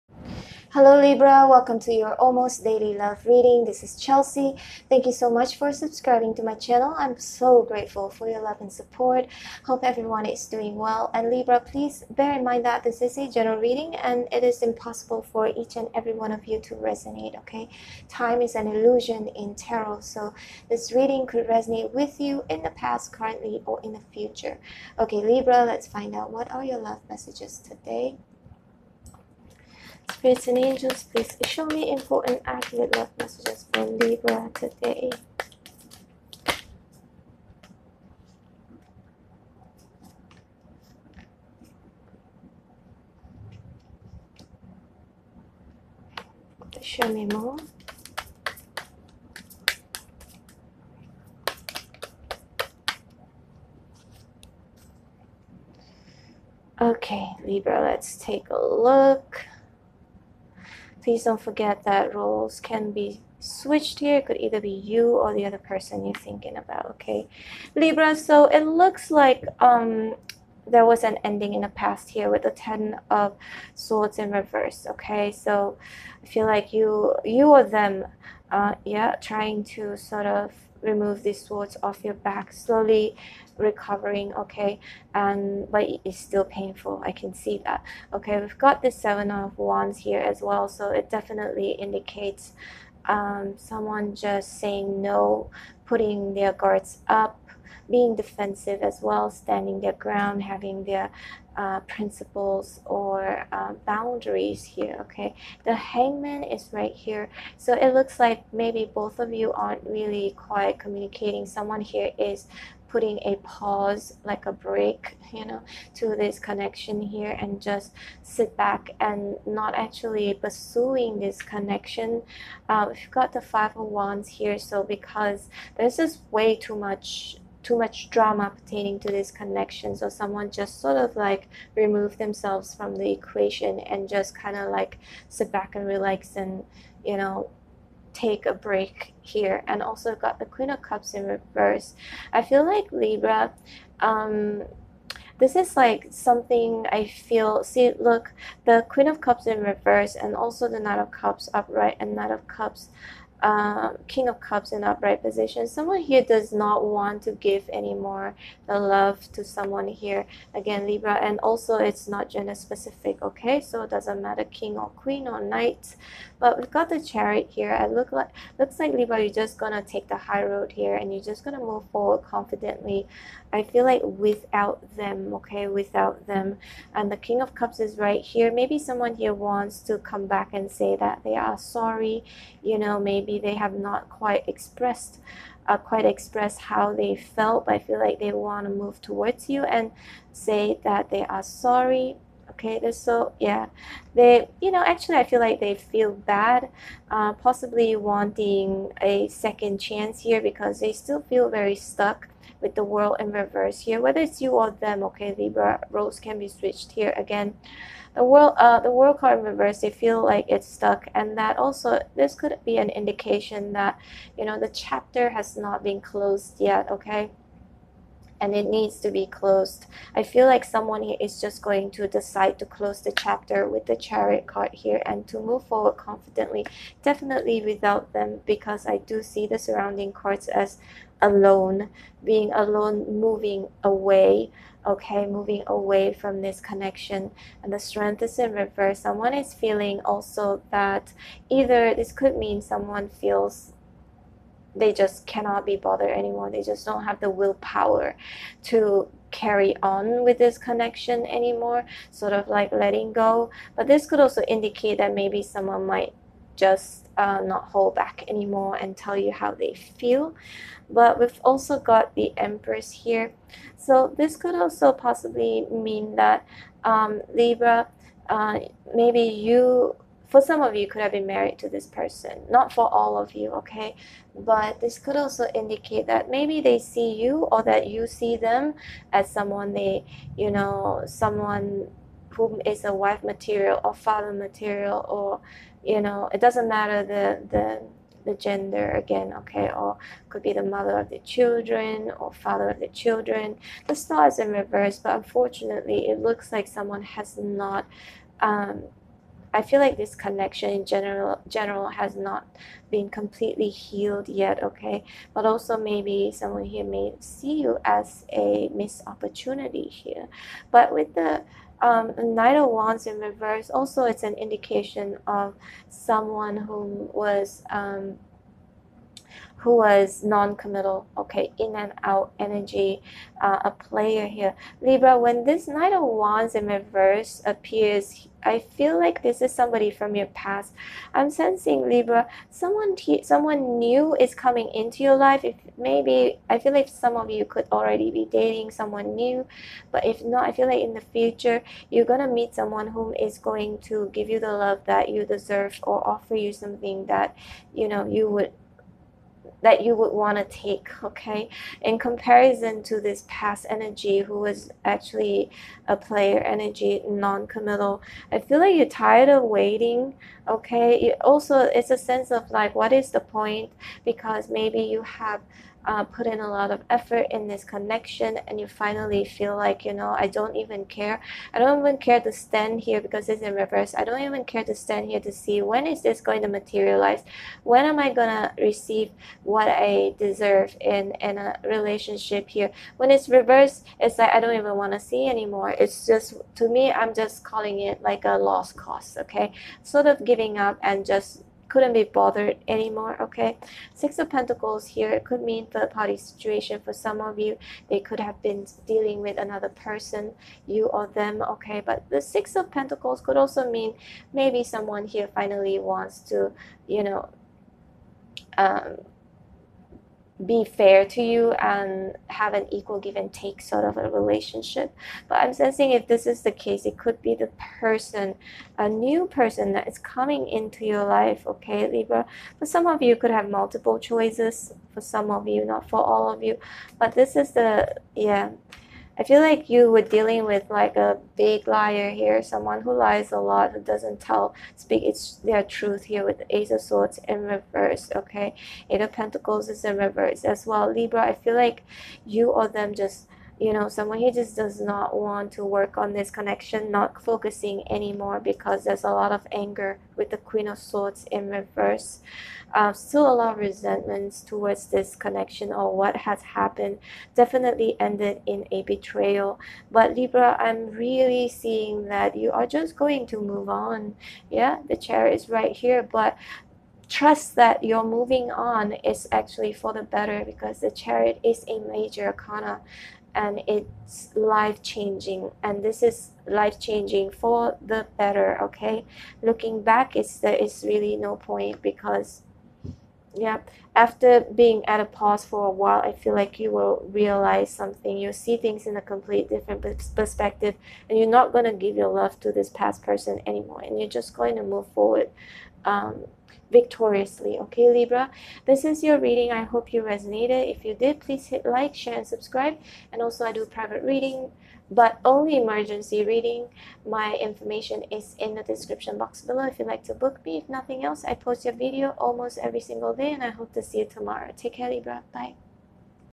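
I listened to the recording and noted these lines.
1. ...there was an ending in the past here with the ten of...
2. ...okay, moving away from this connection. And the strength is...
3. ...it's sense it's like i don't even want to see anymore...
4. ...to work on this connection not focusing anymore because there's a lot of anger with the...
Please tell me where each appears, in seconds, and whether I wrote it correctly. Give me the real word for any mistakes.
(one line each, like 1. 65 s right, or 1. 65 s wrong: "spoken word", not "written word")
1. 70 s right
2. 234 s right
3. 383 s wrong: "reverse", not "sense"
4. 445 s right.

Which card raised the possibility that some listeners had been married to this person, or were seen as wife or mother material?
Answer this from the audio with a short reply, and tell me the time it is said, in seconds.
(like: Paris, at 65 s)
The Empress, at 262 s.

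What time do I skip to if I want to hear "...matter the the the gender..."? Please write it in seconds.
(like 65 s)
286 s.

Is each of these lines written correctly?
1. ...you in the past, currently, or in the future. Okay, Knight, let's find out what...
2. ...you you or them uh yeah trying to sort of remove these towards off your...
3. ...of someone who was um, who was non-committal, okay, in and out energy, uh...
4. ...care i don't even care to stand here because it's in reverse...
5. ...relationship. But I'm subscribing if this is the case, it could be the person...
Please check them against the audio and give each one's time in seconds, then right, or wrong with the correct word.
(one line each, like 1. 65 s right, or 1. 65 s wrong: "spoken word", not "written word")
1. 22 s wrong: "Libra", not "Knight"
2. 76 s wrong: "swords", not "towards"
3. 315 s right
4. 370 s right
5. 414 s wrong: "sensing", not "subscribing".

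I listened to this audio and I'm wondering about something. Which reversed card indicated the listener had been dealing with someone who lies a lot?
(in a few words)
Ace of Swords.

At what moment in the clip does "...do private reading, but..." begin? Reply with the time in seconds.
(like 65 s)
503 s.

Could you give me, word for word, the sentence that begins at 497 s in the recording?
Okay, Libra, this is your reading.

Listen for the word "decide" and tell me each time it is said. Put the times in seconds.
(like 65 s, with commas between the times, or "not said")
222 s.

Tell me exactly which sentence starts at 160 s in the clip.
Again, Libra, and also it's not gender specific, okay?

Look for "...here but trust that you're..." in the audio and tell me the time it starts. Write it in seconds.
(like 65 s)
465 s.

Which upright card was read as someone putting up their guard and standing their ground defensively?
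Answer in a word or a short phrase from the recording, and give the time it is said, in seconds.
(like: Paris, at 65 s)
Seven of Wands, at 88 s.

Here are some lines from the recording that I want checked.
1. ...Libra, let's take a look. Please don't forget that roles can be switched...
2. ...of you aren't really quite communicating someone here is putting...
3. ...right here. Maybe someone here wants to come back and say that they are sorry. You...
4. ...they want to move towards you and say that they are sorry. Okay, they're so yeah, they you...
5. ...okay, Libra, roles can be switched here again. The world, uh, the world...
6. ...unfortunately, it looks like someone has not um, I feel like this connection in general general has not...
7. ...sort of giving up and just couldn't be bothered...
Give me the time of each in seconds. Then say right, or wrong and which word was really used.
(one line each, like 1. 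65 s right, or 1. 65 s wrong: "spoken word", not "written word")
1. 57 s right
2. 109 s right
3. 177 s right
4. 188 s right
5. 205 s right
6. 295 s right
7. 389 s right.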